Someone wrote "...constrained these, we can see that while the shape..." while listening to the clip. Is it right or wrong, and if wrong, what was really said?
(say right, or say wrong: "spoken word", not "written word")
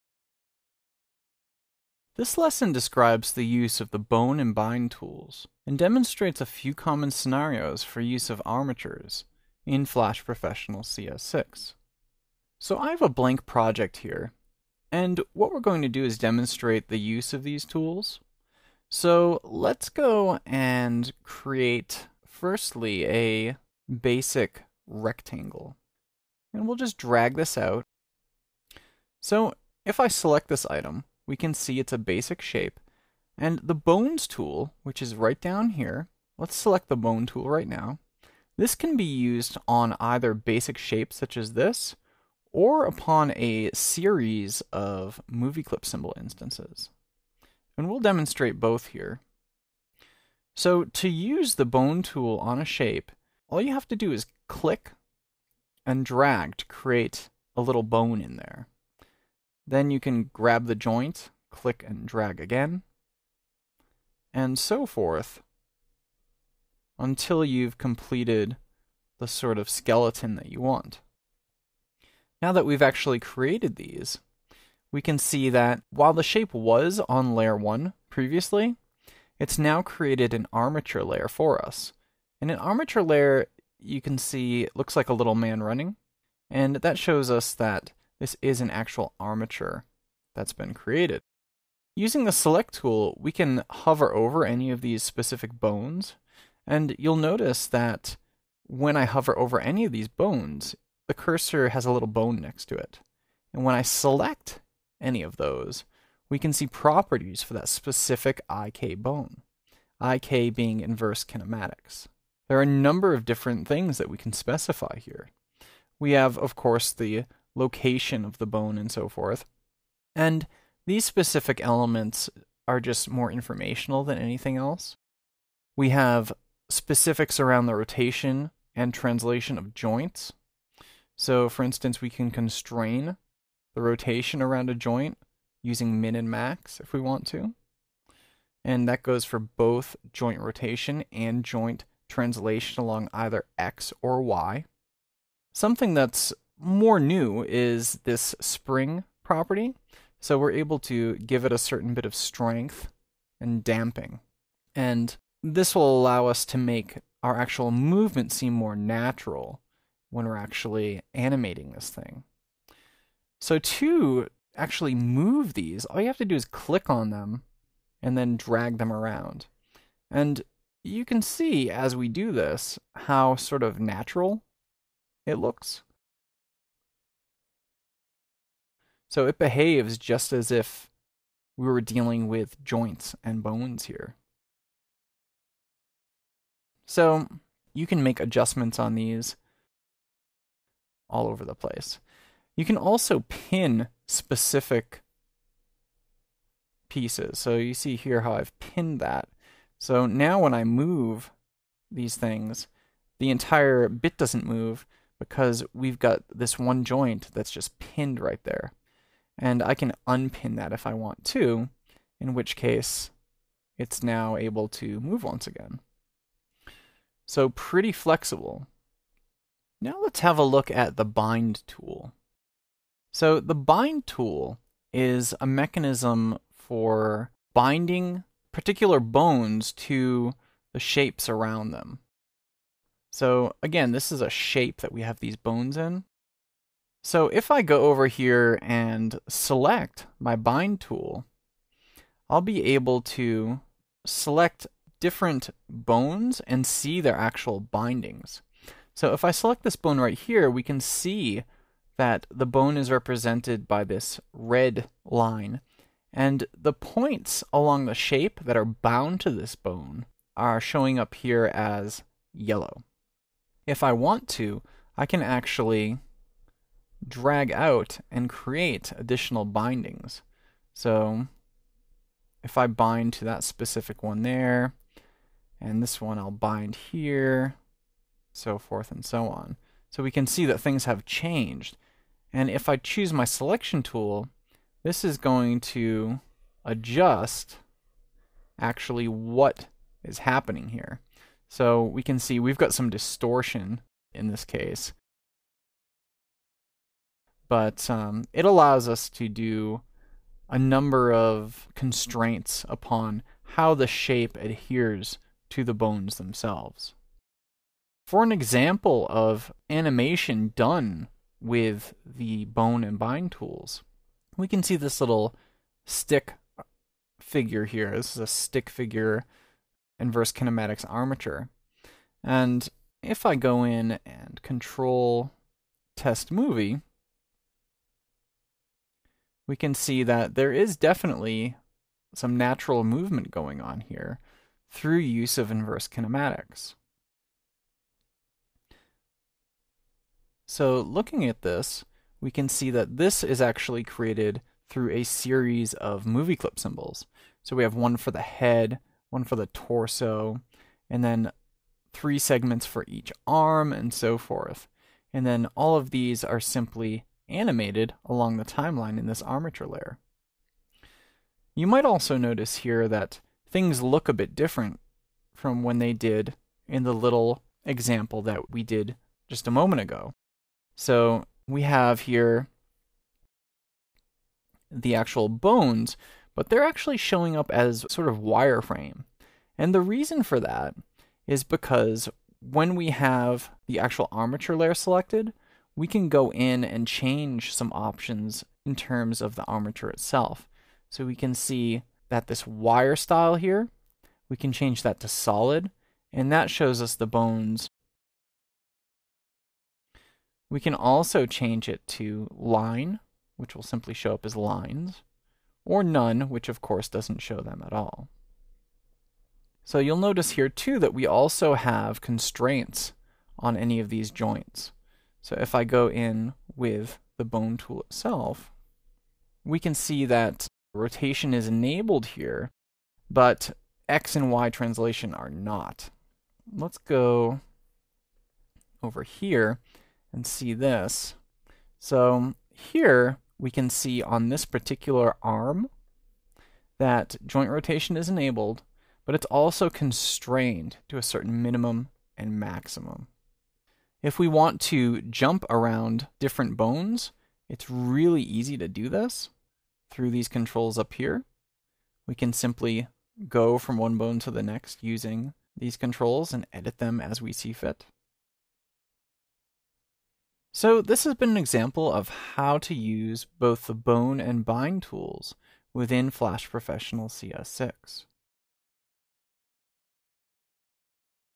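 wrong: "created", not "constrained".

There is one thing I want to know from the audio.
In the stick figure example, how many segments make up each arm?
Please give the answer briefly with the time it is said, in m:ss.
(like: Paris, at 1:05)
3, at 5:51.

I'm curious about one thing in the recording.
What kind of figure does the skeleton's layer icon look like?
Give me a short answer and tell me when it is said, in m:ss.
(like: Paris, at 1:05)
a little man running, at 1:25.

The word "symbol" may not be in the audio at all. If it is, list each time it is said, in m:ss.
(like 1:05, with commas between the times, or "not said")
0:45, 5:46.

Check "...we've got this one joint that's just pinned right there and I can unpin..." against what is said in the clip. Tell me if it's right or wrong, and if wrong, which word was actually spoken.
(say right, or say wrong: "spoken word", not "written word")
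right.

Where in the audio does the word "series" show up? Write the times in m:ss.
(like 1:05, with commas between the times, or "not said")
0:43, 5:45.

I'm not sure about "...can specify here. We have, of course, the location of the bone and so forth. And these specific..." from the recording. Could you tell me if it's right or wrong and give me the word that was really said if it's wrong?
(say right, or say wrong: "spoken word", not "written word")
right.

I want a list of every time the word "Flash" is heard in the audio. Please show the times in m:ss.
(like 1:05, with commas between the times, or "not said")
0:09, 7:46.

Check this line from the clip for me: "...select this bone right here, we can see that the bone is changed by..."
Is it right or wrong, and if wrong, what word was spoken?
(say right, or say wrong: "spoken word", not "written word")
wrong: "represented", not "changed".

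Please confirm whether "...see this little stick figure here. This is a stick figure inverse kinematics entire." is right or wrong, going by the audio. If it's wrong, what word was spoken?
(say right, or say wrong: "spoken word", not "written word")
wrong: "armature", not "entire".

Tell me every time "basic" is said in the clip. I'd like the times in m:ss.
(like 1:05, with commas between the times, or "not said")
0:23, 0:31, 0:40.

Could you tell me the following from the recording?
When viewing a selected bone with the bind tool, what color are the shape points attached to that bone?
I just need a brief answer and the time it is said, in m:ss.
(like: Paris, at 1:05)
yellow, at 4:22.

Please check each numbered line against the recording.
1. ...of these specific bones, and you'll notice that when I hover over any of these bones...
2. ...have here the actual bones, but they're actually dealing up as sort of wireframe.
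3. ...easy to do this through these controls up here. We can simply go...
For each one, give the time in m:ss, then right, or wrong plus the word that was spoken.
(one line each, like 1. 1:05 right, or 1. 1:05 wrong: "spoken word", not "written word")
1. 1:34 right
2. 6:11 wrong: "showing", not "dealing"
3. 7:28 right.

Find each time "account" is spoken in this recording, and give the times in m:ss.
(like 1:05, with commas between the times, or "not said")
not said.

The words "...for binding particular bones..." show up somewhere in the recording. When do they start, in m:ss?
3:46.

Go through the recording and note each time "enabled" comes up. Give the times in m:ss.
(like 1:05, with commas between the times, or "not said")
7:01, 7:18.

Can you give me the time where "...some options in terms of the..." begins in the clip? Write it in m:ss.
6:27.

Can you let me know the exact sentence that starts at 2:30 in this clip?
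So we're able to give it a certain bit of strength and damping.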